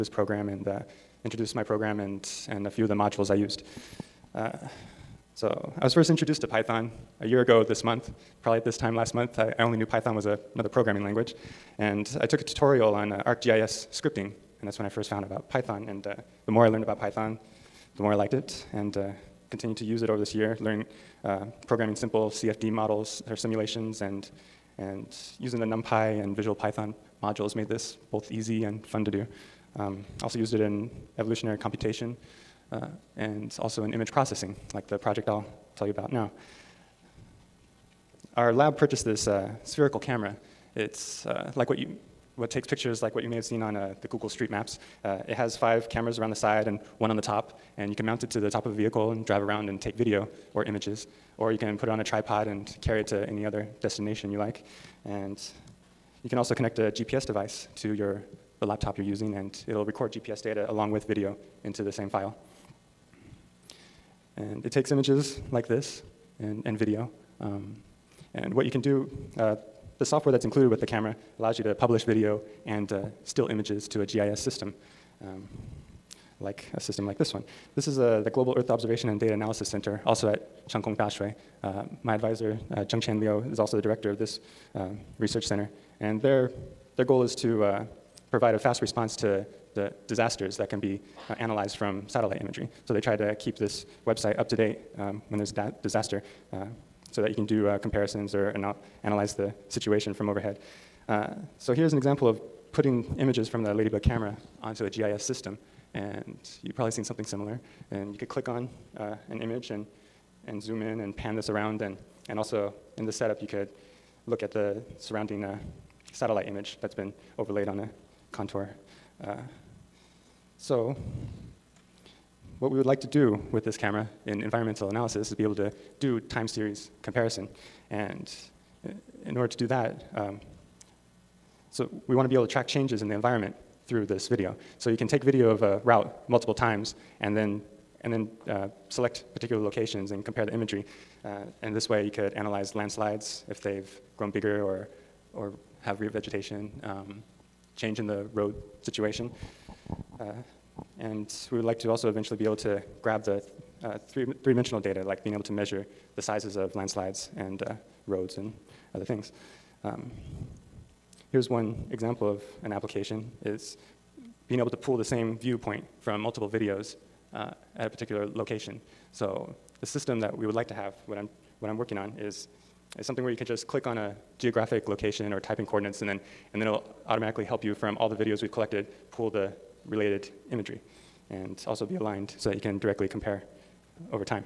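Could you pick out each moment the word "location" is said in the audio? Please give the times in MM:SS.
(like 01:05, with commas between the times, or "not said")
02:19, 02:48, 02:54.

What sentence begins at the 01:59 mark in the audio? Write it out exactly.
Uh, so what we would like to do with this camera in environmental analysis is be able to do time series comparison.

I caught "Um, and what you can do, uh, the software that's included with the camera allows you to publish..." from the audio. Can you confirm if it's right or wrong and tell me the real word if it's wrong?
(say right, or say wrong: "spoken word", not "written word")
right.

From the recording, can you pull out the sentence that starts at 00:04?
Uh, so I was first introduced to Python a year ago this month probably at this time last month.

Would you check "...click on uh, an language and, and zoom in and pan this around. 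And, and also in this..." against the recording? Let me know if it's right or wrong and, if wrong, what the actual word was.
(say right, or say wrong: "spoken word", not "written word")
wrong: "image", not "language".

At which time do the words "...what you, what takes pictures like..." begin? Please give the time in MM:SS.
00:41.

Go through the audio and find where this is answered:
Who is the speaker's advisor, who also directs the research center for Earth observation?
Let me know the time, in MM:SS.
01:22.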